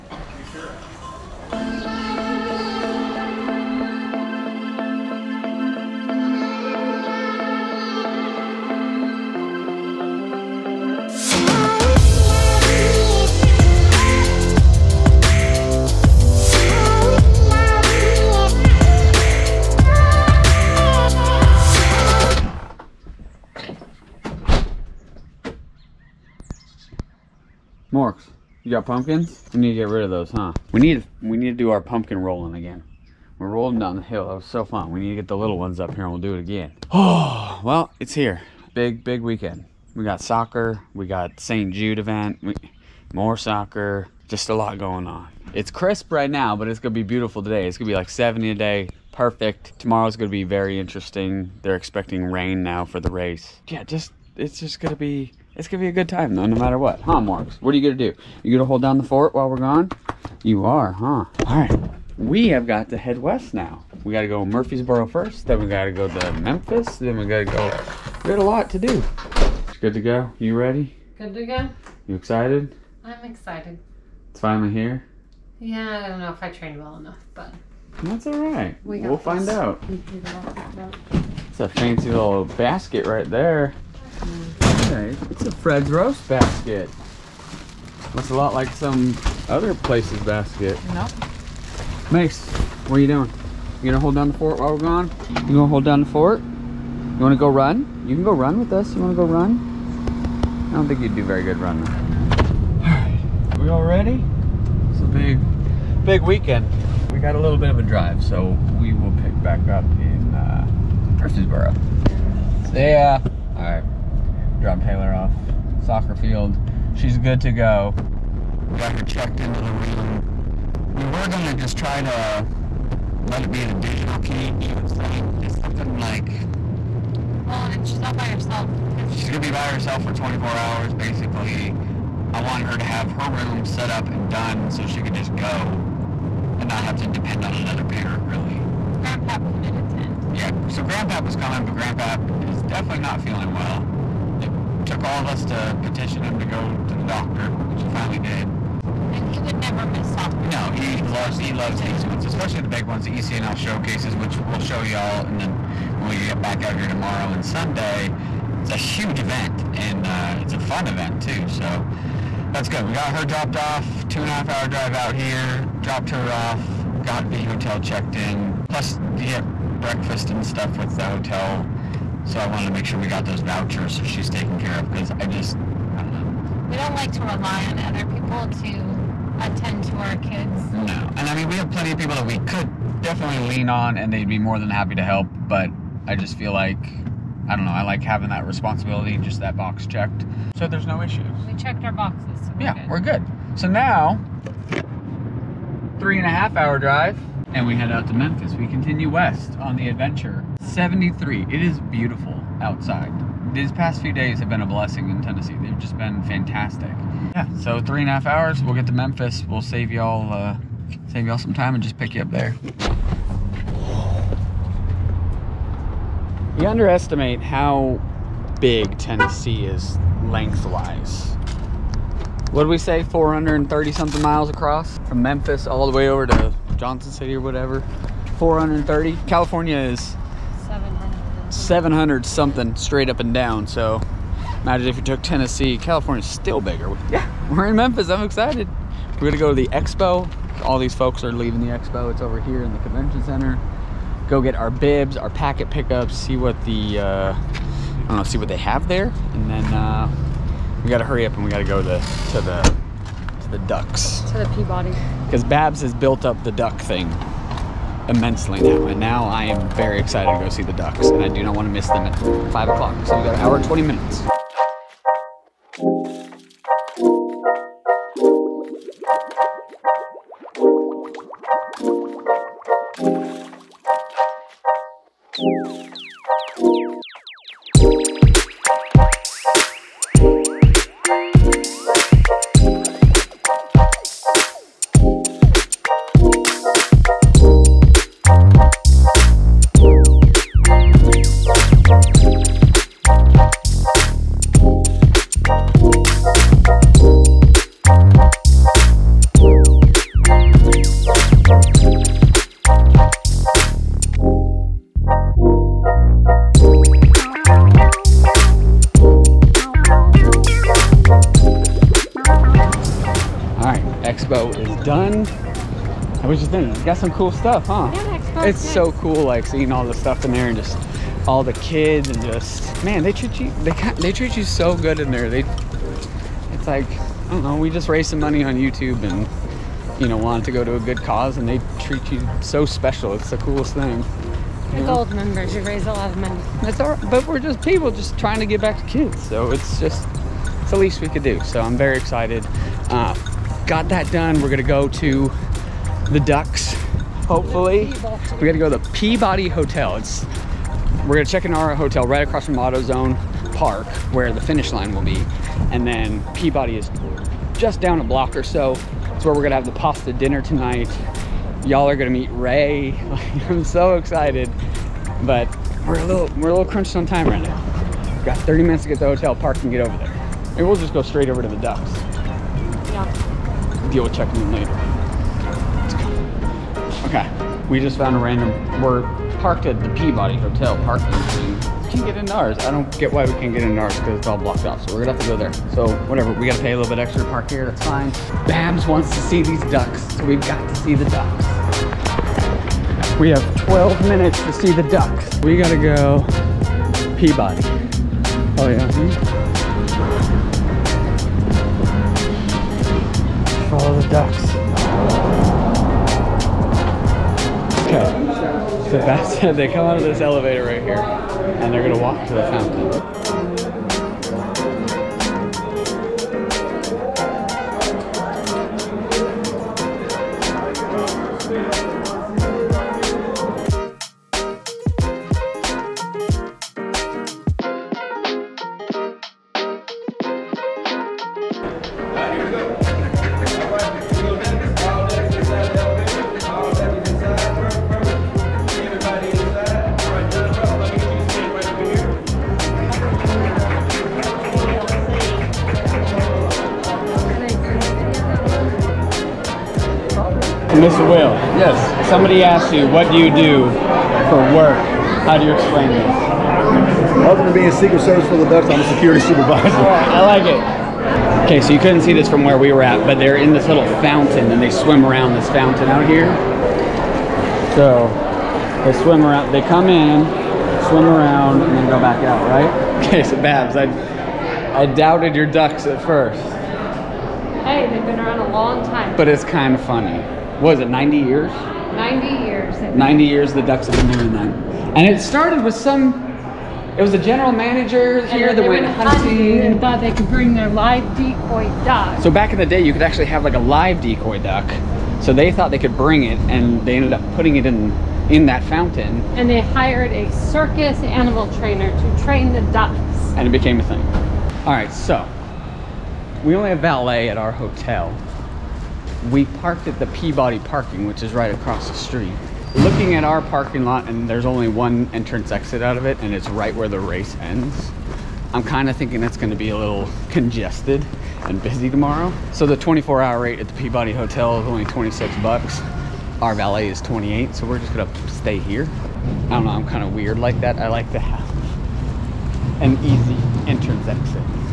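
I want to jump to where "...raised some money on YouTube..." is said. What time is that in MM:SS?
05:27.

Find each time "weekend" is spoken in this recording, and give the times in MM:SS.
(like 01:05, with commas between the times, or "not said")
00:39, 01:46.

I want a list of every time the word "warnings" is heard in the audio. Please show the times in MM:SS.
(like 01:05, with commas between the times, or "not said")
not said.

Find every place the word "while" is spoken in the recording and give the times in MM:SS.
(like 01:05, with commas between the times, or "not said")
00:59, 01:34.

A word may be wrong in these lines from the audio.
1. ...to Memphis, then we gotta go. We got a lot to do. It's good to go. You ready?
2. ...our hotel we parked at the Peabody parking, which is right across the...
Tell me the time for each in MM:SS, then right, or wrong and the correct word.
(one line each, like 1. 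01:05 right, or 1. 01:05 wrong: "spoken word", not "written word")
1. 01:06 right
2. 08:27 right.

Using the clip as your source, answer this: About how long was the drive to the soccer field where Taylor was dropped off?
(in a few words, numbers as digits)
two and a half hour.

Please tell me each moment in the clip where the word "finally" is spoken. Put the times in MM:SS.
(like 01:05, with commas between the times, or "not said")
01:14, 02:27.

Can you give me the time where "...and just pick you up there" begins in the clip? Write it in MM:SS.
03:31.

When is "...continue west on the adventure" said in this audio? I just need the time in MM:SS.
03:18.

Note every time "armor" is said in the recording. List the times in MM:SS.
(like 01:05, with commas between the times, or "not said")
not said.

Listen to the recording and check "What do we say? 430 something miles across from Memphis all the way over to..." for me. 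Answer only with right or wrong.
right.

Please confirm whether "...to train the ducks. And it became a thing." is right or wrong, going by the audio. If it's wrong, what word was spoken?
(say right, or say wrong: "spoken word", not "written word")
right.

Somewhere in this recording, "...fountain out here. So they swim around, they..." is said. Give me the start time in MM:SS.
07:45.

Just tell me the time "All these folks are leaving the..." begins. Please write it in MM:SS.
04:00.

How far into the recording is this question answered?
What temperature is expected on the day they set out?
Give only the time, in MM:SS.
00:48.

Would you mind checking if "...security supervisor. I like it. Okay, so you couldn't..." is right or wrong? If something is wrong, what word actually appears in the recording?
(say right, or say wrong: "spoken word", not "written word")
right.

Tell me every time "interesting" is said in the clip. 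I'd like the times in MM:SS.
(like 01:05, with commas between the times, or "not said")
00:50.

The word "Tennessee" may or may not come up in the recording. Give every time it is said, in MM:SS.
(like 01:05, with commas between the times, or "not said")
03:25, 03:38, 03:55.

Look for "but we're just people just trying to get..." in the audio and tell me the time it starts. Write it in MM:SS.
05:37.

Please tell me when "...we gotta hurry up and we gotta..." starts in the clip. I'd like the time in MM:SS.
04:10.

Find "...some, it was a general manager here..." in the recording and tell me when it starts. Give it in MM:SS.
08:05.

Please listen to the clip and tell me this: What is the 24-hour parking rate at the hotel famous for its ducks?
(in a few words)
$26.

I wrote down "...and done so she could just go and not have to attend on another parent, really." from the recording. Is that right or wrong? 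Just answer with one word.
wrong.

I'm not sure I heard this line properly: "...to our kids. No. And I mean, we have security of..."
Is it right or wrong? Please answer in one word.
wrong.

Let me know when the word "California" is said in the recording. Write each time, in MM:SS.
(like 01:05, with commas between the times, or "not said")
03:49, 03:55.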